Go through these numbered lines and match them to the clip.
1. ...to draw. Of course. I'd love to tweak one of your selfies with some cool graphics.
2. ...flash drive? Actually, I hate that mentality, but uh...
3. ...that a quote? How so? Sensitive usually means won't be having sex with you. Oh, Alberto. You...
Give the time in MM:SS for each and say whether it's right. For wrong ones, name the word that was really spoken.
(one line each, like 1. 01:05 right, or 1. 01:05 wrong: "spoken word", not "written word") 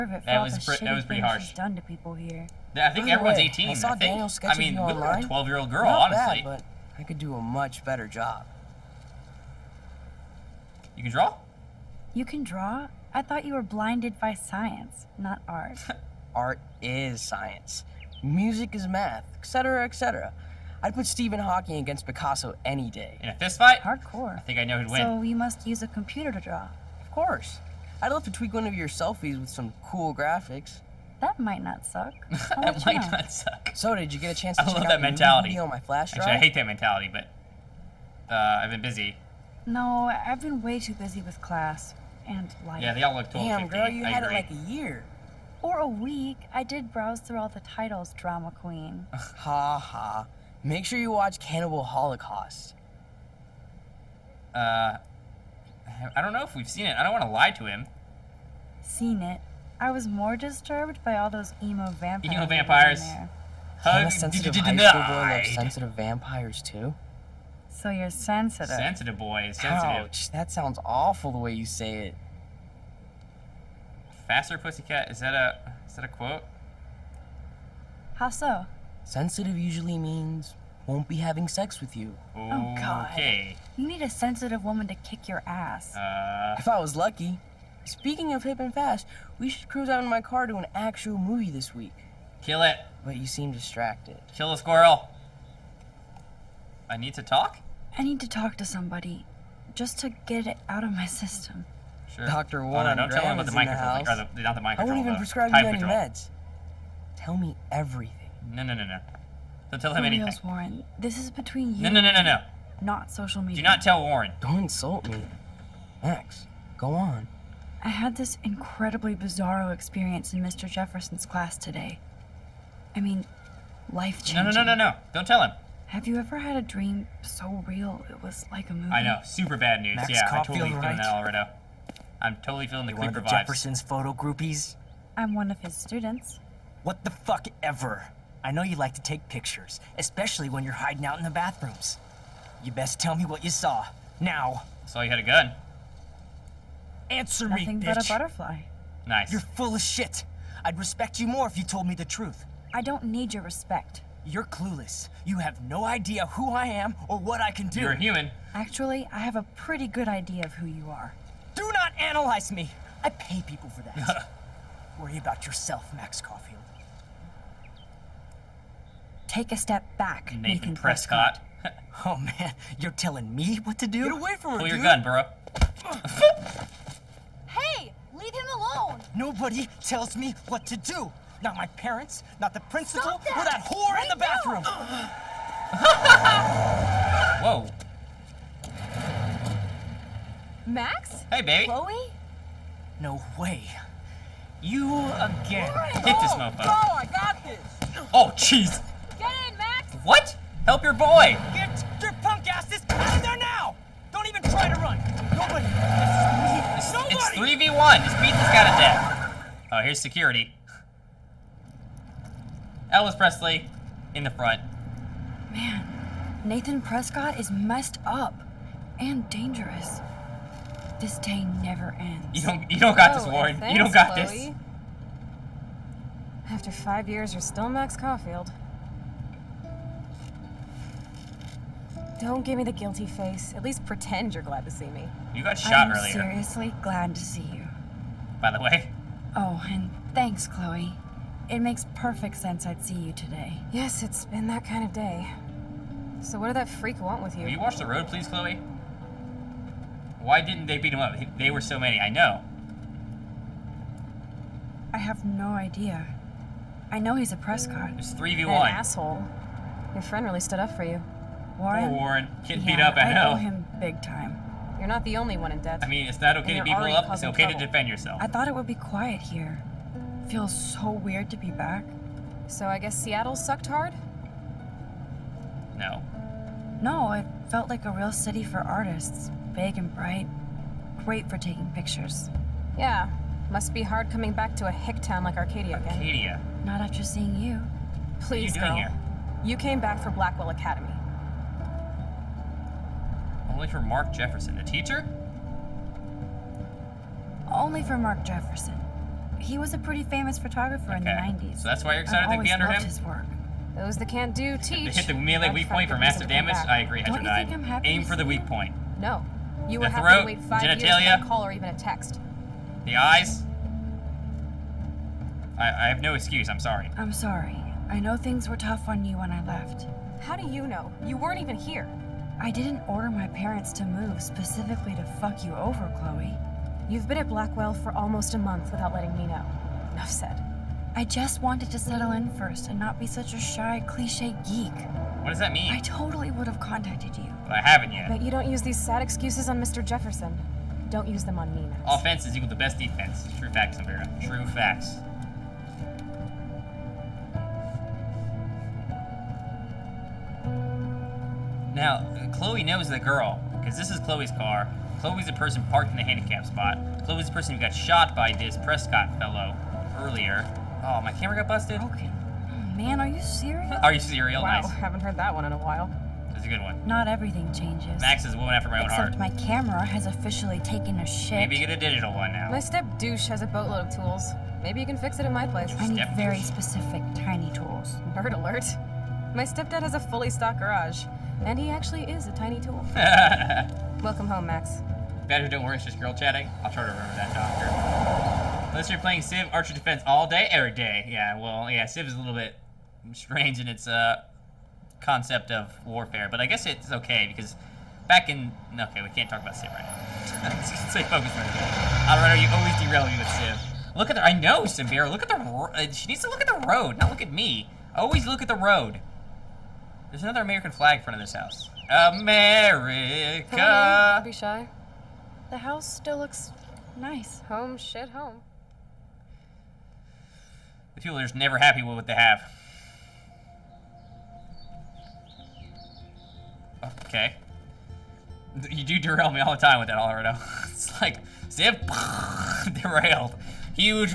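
1. 00:26 right
2. 00:35 right
3. 01:15 wrong: "God", not "Alberto".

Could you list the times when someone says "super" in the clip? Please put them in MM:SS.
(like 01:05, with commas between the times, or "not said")
02:09.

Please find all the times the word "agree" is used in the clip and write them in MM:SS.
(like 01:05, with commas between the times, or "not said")
00:44, 05:06.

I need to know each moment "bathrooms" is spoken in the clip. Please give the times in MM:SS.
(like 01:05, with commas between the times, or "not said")
02:21, 03:04.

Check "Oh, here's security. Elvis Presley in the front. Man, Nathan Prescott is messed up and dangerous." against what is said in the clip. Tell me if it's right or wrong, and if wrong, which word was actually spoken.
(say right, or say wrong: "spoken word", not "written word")
right.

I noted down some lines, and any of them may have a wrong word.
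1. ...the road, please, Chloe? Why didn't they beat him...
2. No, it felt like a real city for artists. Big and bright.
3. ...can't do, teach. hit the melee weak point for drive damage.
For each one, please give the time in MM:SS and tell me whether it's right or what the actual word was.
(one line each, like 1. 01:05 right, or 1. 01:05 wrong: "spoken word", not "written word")
1. 04:07 right
2. 04:36 right
3. 05:04 wrong: "massive", not "drive".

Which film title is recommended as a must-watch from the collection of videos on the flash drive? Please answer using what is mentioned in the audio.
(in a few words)
Cannibal Holocaust.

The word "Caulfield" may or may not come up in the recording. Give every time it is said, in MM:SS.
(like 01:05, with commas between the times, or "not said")
02:10, 02:46, 03:47.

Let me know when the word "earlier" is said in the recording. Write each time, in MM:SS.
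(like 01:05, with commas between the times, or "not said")
03:55, 05:59.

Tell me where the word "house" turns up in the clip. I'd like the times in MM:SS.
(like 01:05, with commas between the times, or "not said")
06:51, 06:55.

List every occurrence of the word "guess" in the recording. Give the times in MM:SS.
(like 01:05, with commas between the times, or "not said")
04:32, 06:36.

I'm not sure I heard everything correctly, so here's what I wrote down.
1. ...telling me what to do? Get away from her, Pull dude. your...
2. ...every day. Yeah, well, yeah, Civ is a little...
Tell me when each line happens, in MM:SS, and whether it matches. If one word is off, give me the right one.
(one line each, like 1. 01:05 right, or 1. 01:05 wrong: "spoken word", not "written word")
1. 02:52 right
2. 06:30 right.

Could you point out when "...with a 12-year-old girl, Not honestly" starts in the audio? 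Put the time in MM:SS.
00:04.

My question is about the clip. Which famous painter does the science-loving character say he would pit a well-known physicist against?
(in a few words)
Picasso.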